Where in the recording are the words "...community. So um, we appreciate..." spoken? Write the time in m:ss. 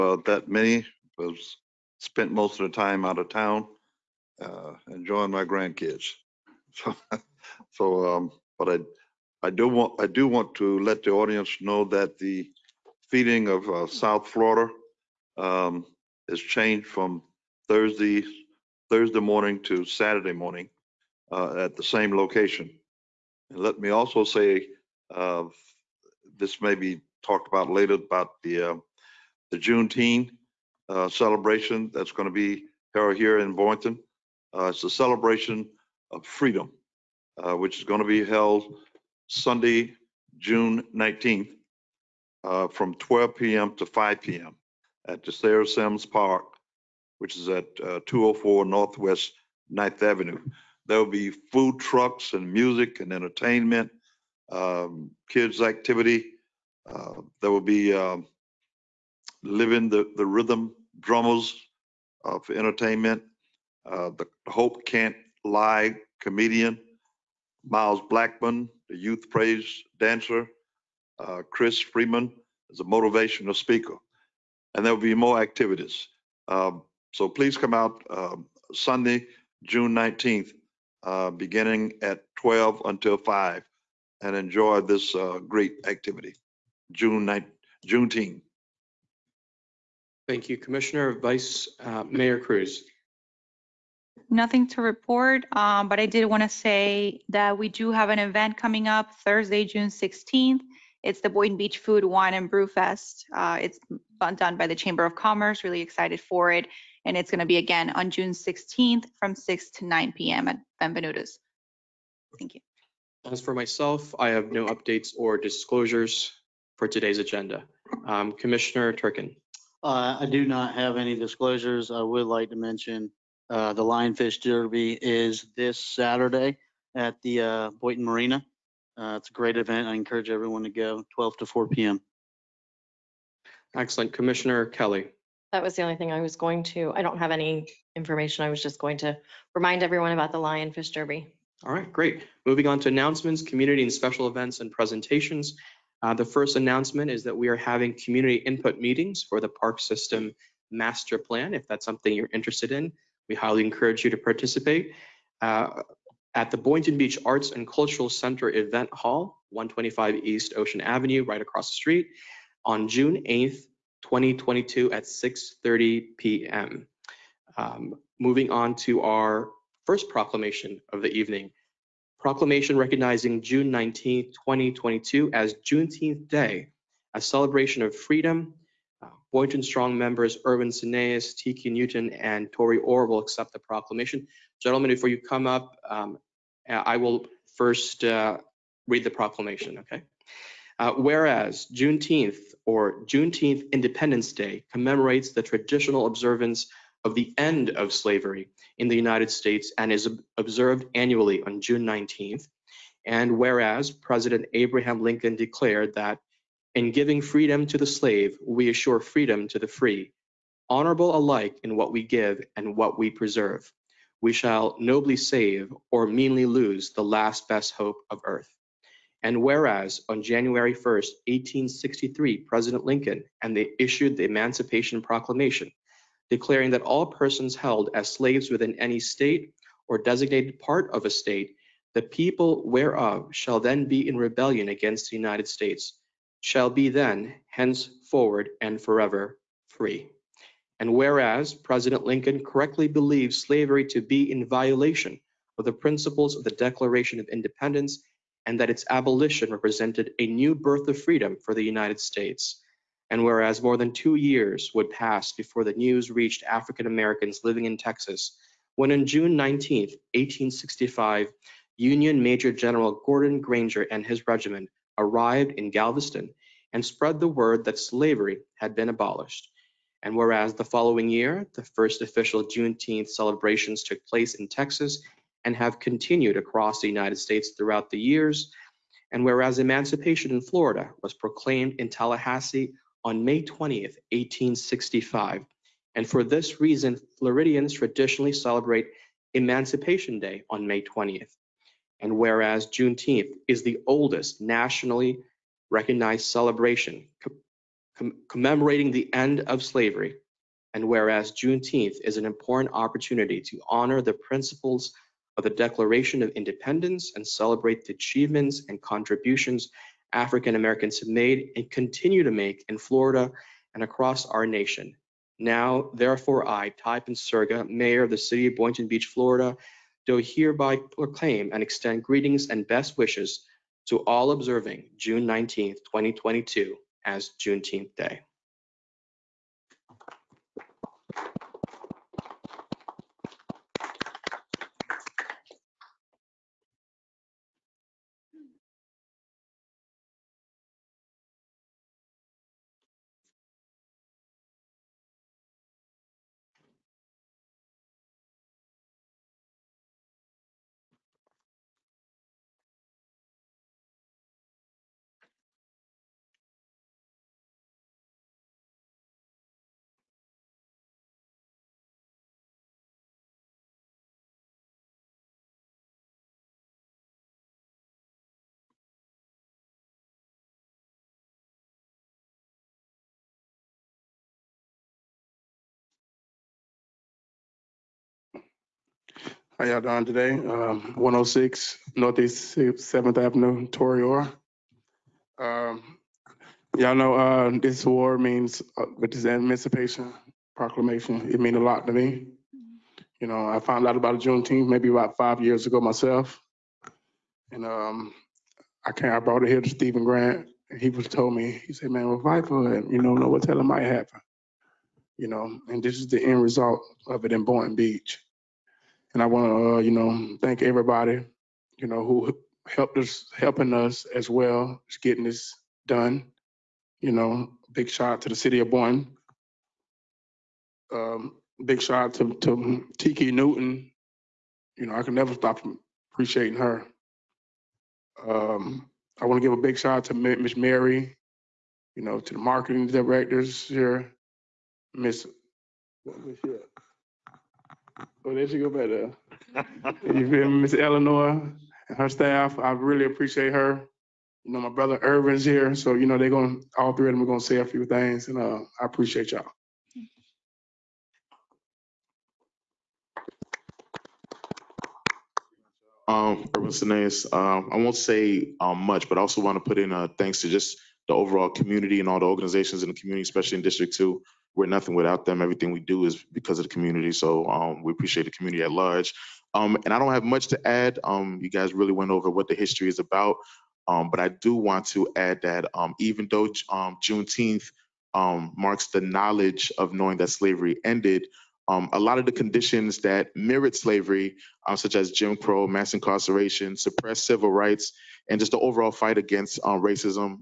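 7:46.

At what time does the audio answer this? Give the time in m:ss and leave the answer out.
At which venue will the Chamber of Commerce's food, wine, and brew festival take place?
1:50.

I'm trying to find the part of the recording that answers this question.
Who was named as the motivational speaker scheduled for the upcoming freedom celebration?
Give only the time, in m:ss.
1:11.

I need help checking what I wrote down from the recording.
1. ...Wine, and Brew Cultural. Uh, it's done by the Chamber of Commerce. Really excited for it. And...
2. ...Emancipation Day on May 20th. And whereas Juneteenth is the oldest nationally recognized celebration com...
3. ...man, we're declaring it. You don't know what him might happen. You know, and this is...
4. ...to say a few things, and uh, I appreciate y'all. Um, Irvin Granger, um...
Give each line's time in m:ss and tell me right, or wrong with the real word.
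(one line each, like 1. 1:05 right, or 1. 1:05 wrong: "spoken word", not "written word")
1. 1:42 wrong: "Fest", not "Cultural"
2. 4:49 right
3. 6:41 wrong: "fighting", not "declaring"
4. 7:27 wrong: "Sines", not "Granger".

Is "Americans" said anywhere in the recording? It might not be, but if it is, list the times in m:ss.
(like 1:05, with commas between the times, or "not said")
4:16, 5:10.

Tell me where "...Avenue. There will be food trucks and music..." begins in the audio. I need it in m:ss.
0:50.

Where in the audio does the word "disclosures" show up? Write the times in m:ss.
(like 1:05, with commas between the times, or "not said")
1:55, 2:01.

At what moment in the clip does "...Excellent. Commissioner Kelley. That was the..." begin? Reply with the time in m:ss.
2:13.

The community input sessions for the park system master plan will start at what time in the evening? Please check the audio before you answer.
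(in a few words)
6:30 p.m.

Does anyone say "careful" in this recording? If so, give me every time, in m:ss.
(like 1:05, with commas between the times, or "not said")
not said.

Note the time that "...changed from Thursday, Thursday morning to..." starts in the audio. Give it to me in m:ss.
0:16.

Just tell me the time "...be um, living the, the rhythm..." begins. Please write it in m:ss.
0:57.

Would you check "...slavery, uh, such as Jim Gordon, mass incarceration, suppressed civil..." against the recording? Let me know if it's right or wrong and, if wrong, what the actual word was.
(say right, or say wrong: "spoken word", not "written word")
wrong: "Crow", not "Gordon".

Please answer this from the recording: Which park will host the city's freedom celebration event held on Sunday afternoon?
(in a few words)
Sarah Sims Park.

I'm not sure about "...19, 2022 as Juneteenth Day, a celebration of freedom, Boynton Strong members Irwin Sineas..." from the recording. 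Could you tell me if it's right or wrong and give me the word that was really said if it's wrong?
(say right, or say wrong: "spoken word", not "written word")
right.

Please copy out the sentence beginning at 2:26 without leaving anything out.
Uh, the first announcement is that we are having community input meetings for the park system master plan.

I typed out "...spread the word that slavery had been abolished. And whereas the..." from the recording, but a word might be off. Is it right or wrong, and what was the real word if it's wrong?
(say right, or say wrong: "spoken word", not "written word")
right.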